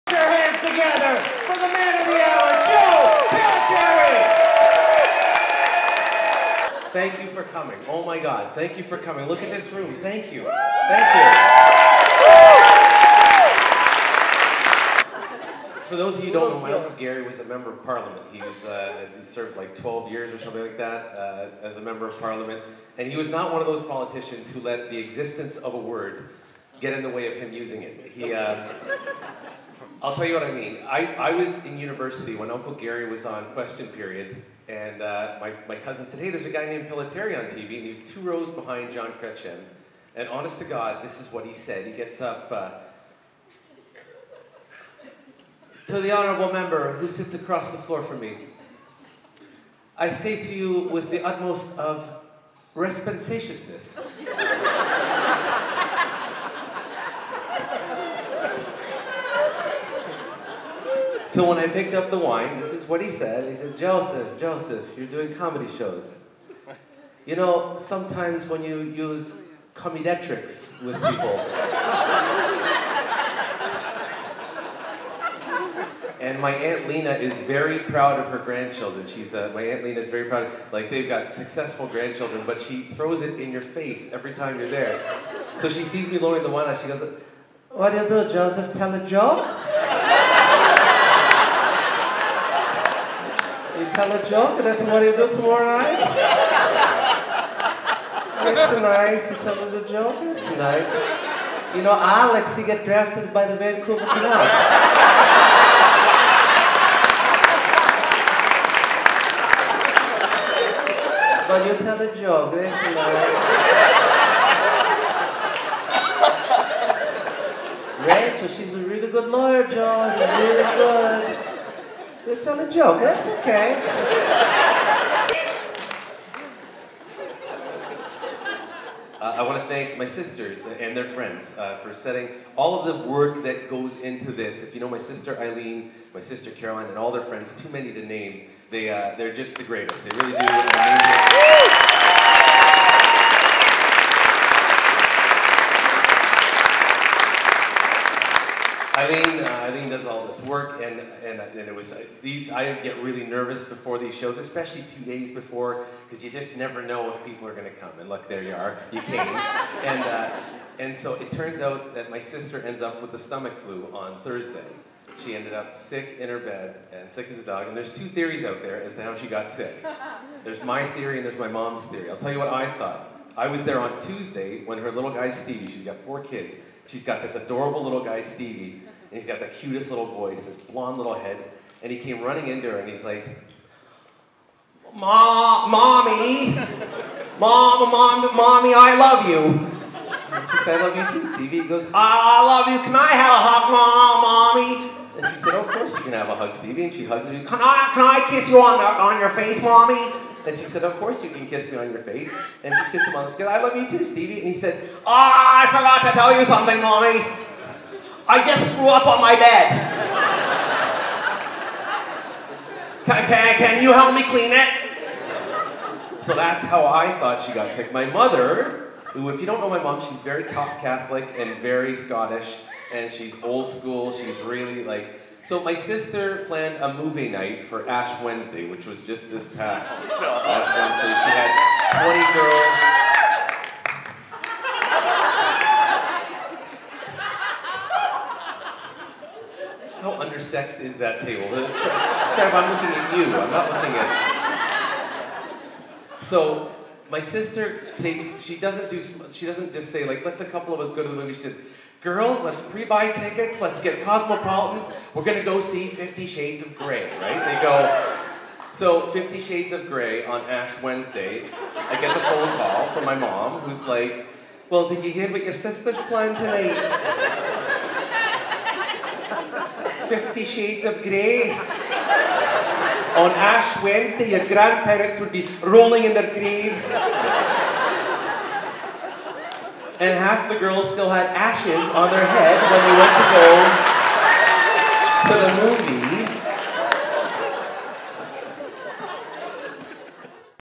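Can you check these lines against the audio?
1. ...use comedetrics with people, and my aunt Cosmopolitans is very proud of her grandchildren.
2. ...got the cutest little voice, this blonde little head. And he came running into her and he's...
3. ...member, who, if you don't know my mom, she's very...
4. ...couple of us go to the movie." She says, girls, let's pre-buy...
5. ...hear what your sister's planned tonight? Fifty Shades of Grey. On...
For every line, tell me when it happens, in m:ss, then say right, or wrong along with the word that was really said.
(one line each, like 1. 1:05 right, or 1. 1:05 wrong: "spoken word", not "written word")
1. 1:08 wrong: "Lena", not "Cosmopolitans"
2. 2:59 right
3. 3:38 wrong: "mother", not "member"
4. 4:10 right
5. 4:25 right.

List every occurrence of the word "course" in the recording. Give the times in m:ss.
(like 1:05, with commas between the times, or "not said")
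3:15, 3:20.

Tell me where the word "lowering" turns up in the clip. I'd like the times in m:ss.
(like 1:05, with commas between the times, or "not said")
1:26.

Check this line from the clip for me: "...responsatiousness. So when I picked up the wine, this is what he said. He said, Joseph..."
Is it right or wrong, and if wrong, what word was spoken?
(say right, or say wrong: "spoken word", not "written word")
right.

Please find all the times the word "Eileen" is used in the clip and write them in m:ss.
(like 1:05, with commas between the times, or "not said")
2:15, 2:29.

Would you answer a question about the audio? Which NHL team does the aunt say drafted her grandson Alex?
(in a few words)
Vancouver Canucks.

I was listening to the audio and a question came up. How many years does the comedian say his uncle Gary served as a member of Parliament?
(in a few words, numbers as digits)
12.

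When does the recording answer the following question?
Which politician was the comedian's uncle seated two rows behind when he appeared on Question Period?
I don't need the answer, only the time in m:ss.
0:38.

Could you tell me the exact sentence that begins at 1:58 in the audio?
Rachel, she's a really good lawyer, John, really good.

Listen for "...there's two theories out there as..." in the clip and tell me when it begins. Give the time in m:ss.
2:47.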